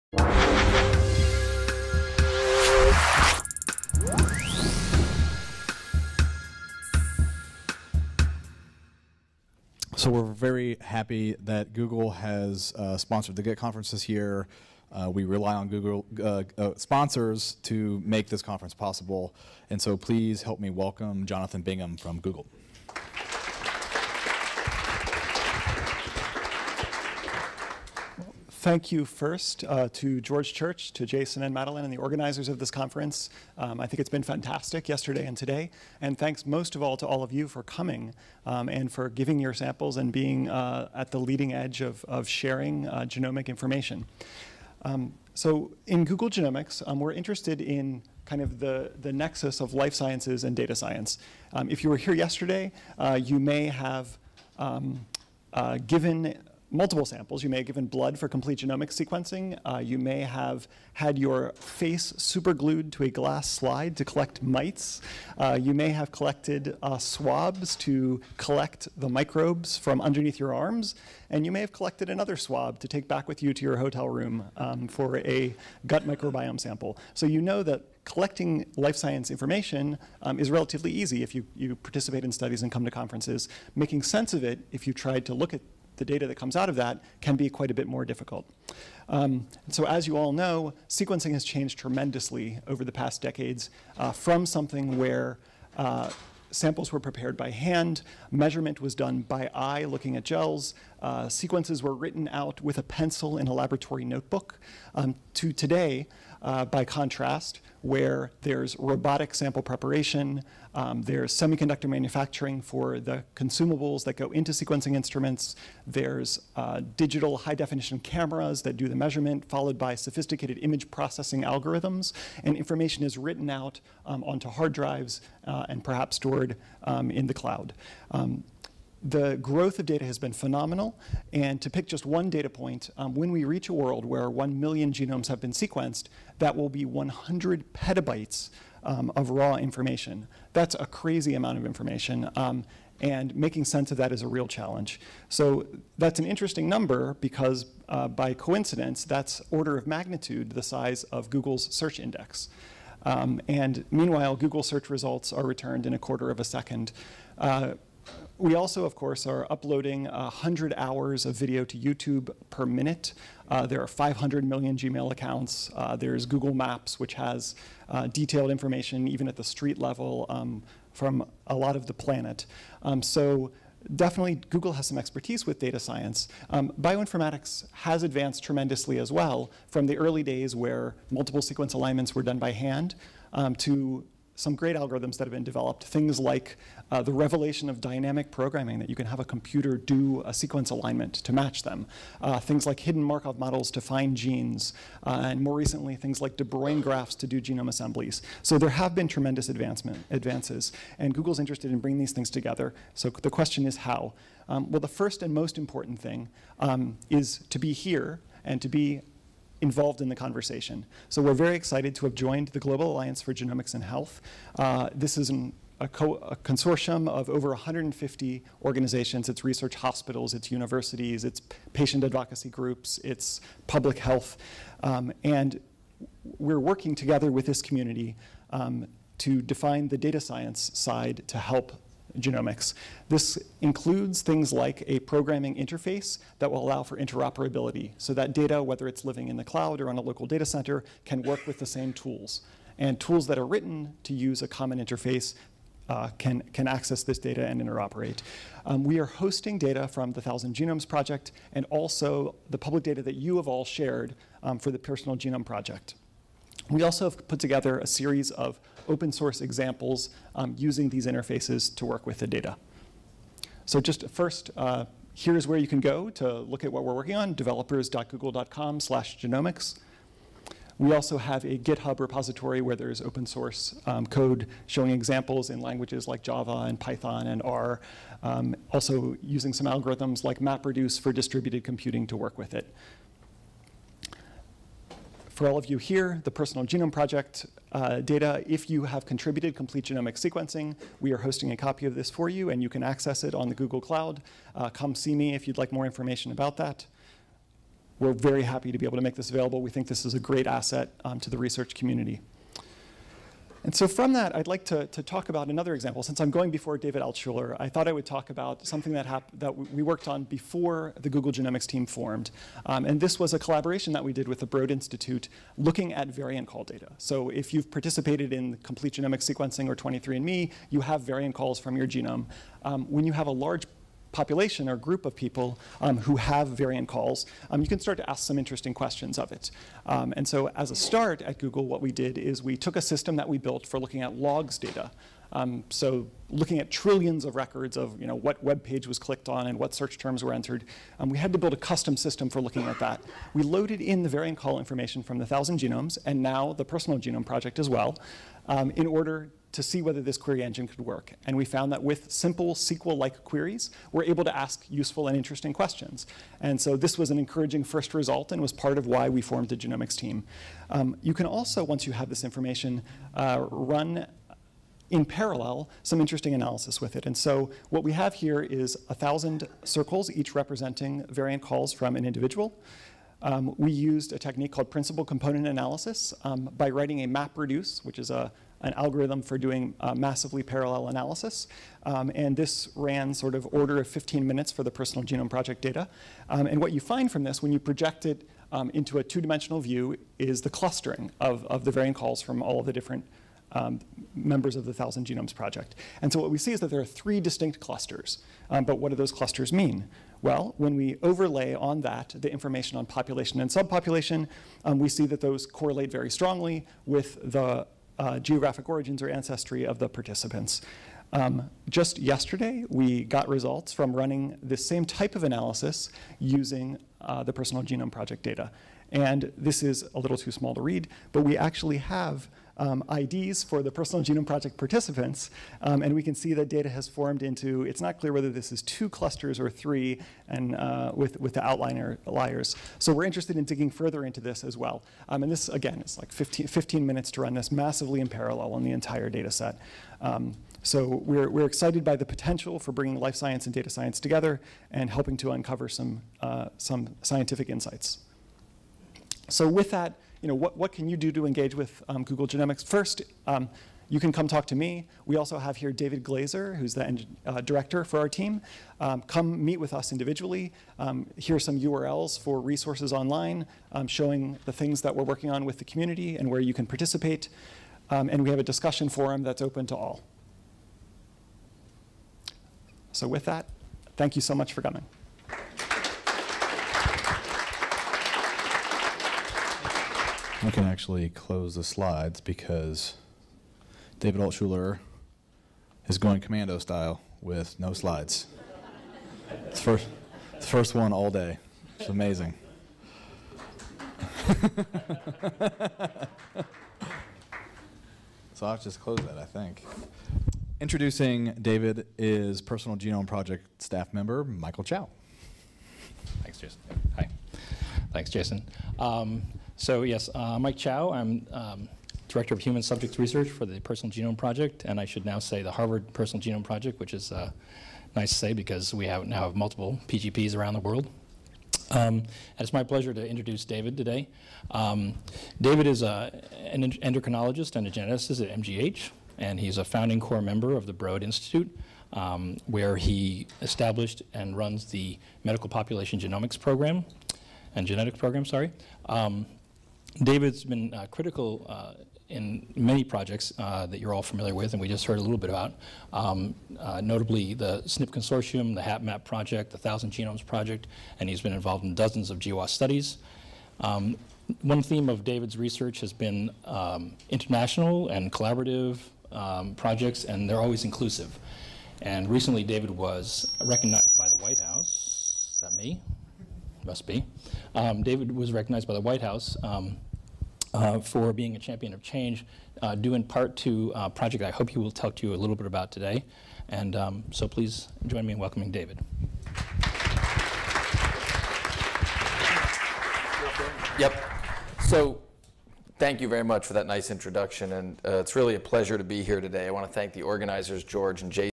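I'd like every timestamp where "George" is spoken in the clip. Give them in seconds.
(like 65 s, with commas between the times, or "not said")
30 s, 590 s.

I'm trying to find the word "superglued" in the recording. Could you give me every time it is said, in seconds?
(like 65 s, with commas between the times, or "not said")
62 s.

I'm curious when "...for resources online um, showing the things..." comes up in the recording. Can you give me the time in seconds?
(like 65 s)
462 s.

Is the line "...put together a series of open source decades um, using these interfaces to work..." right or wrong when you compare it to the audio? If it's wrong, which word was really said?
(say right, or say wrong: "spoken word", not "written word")
wrong: "examples", not "decades".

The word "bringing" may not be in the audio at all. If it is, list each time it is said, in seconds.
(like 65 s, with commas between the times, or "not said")
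201 s, 442 s.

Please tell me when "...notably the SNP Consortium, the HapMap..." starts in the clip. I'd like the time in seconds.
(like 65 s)
546 s.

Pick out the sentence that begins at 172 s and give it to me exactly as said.
Um, so definitely Google has some expertise with data science.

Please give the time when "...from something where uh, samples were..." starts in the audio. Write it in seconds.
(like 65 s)
94 s.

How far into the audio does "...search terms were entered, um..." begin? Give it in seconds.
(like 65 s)
339 s.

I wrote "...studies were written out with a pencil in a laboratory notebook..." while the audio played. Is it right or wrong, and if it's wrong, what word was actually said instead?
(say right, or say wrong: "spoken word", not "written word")
wrong: "sequences", not "studies".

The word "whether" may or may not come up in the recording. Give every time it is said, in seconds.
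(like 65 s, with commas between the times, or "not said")
238 s, 349 s, 428 s.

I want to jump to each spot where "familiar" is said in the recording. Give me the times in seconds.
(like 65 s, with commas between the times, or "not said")
544 s.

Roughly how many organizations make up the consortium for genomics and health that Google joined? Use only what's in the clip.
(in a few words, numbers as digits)
over 150.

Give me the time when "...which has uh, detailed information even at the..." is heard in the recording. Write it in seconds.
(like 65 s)
166 s.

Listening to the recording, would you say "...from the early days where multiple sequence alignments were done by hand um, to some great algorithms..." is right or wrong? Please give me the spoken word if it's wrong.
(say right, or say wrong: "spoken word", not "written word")
right.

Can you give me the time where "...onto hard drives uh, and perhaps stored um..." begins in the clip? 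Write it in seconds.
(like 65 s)
124 s.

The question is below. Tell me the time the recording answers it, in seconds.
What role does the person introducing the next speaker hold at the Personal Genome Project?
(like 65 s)
512 s.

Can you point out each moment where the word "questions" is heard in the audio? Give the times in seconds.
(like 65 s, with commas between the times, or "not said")
203 s, 328 s, 355 s.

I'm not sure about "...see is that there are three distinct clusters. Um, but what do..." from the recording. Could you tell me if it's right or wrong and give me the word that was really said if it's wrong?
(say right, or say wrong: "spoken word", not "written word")
right.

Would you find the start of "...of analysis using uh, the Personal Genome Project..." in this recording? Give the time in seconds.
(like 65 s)
415 s.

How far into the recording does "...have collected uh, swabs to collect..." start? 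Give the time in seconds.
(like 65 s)
65 s.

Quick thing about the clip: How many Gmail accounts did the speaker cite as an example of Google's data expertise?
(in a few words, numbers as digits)
500 million.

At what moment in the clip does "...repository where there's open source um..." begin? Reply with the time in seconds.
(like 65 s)
271 s.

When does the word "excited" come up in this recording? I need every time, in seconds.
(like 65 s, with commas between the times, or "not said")
211 s, 441 s.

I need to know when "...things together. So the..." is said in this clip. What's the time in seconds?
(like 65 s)
202 s.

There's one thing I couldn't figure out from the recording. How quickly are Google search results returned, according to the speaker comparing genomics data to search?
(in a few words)
a quarter of a second.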